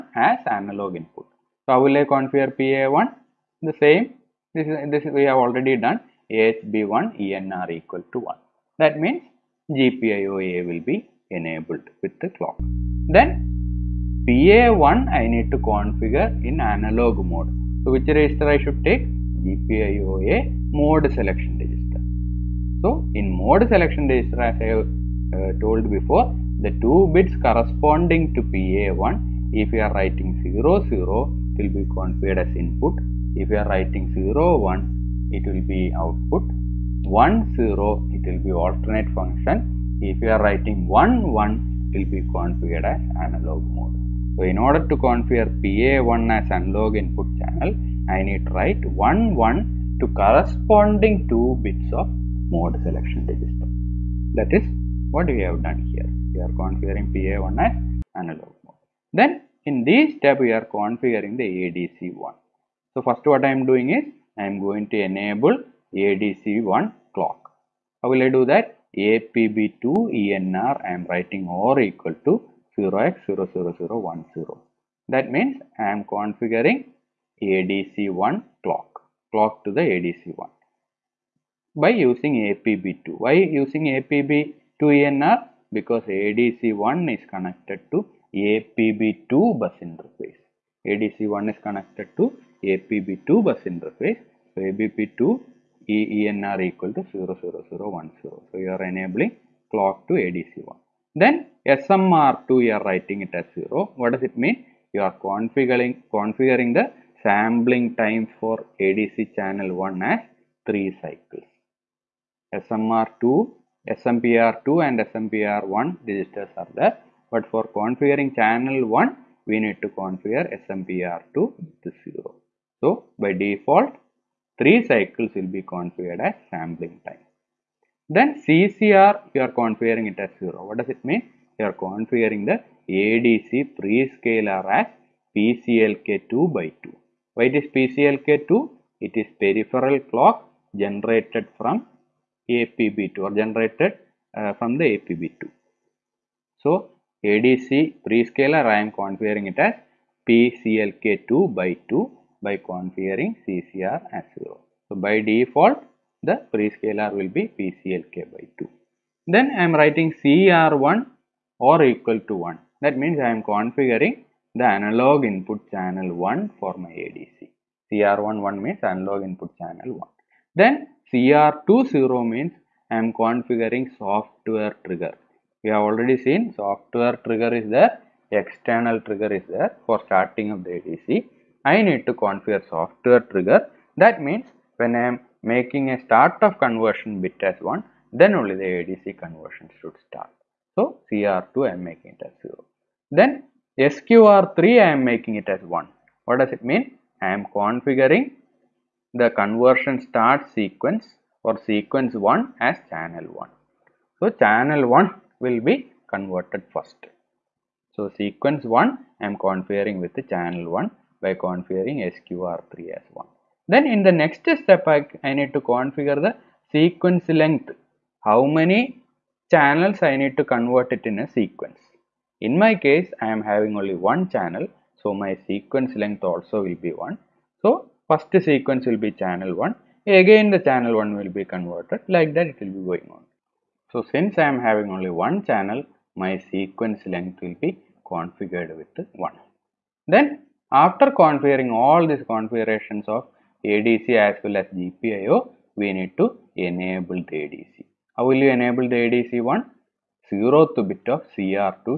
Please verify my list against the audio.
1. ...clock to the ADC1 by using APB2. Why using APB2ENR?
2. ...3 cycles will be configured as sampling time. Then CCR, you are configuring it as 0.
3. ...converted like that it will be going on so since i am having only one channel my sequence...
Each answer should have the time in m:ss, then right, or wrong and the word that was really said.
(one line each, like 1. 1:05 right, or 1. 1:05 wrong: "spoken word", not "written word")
1. 1:19 right
2. 2:04 right
3. 3:51 right.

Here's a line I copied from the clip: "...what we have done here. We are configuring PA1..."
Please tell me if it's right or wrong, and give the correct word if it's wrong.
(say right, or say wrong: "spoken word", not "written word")
right.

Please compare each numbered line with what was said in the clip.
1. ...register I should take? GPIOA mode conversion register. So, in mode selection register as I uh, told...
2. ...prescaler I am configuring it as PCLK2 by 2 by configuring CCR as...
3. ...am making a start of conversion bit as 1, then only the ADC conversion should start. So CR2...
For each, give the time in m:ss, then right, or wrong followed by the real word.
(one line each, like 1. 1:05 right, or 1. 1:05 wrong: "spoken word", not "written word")
1. 0:18 wrong: "selection", not "conversion"
2. 2:28 right
3. 3:05 right.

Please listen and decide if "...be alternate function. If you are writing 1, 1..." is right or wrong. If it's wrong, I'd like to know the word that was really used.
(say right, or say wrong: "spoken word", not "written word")
right.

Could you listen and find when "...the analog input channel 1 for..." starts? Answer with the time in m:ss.
2:44.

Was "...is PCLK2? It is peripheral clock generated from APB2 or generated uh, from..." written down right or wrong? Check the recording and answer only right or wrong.
right.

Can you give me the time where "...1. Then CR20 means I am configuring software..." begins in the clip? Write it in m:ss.
2:49.